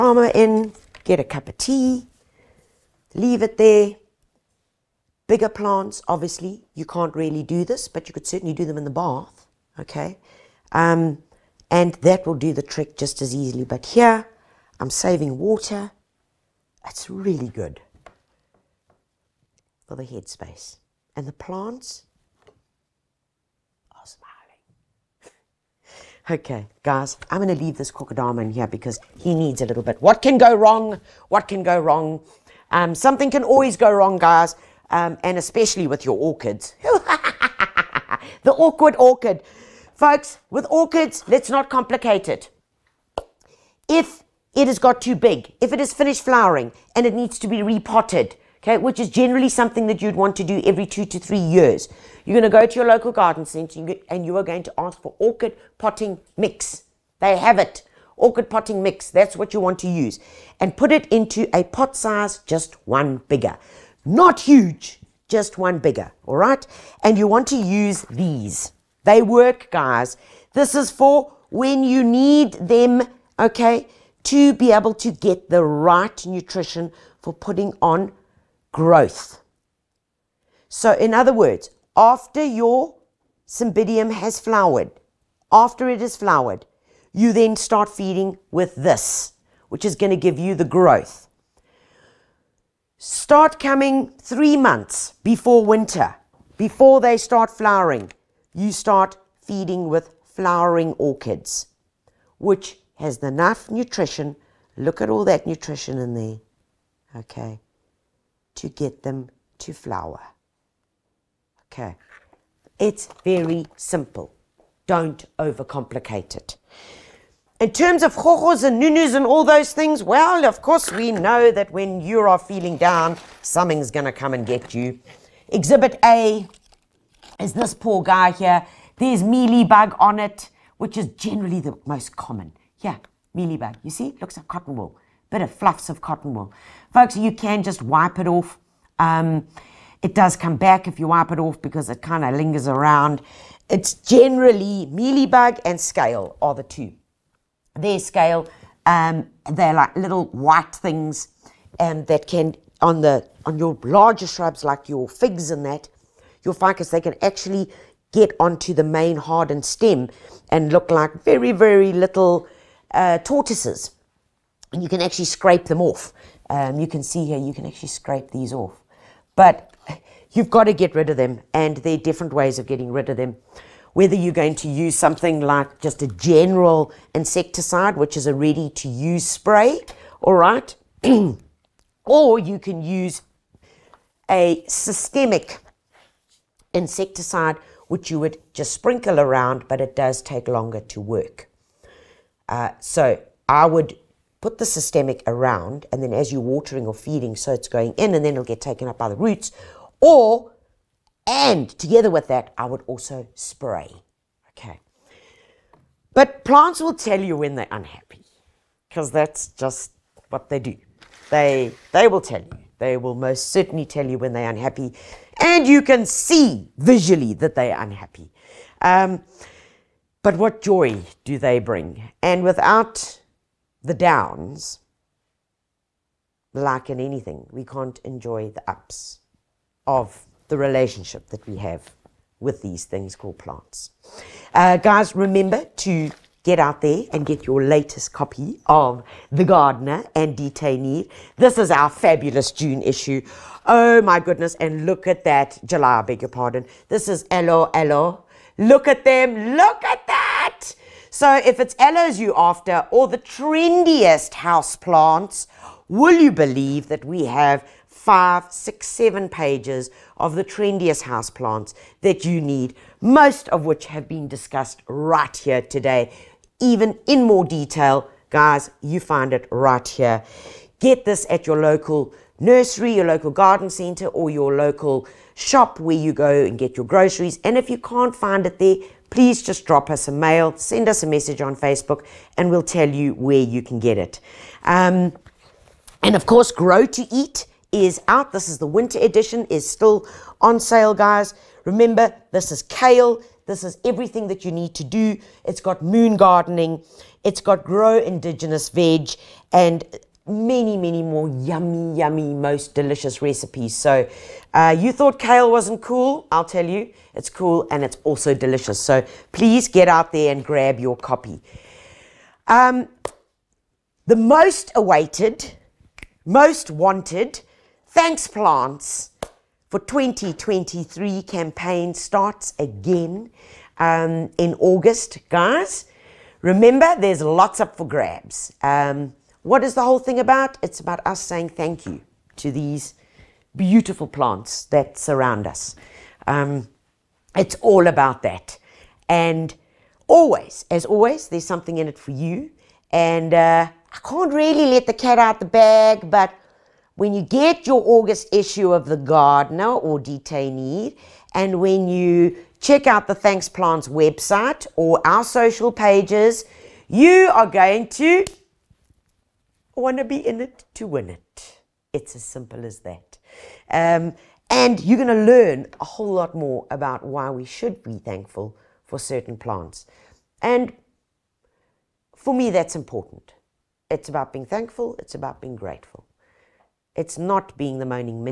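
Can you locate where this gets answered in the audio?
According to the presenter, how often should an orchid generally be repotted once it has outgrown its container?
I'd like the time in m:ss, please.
0:50.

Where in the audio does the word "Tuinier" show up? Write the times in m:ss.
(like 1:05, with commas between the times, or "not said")
4:00, 5:50.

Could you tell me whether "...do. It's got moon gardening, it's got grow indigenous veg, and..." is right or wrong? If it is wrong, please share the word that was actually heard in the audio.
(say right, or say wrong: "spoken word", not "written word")
right.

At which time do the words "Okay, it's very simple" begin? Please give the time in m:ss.
1:51.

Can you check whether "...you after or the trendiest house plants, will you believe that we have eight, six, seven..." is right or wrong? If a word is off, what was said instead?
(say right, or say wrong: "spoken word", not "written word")
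wrong: "five", not "eight".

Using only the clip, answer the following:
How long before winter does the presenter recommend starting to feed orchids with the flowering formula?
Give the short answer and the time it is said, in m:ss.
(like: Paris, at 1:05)
3 months, at 1:34.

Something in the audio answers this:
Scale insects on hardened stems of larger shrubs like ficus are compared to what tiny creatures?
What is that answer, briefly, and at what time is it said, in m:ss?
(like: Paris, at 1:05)
Tortoises, at 2:43.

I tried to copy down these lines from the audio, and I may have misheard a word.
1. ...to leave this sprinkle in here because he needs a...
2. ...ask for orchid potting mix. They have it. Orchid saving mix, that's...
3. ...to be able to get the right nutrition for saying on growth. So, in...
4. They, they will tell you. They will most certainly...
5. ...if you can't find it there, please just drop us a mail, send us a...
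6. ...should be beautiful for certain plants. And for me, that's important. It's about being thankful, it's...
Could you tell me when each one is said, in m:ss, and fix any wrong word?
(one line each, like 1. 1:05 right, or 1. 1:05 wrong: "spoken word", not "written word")
1. 0:27 wrong: "crocodile", not "sprinkle"
2. 0:54 wrong: "potting", not "saving"
3. 1:14 wrong: "putting", not "saying"
4. 3:31 right
5. 4:37 right
6. 6:07 wrong: "thankful", not "beautiful".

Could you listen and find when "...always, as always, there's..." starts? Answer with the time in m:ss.
5:40.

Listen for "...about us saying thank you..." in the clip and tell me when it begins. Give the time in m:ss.
5:30.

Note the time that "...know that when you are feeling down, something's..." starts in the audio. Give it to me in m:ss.
2:01.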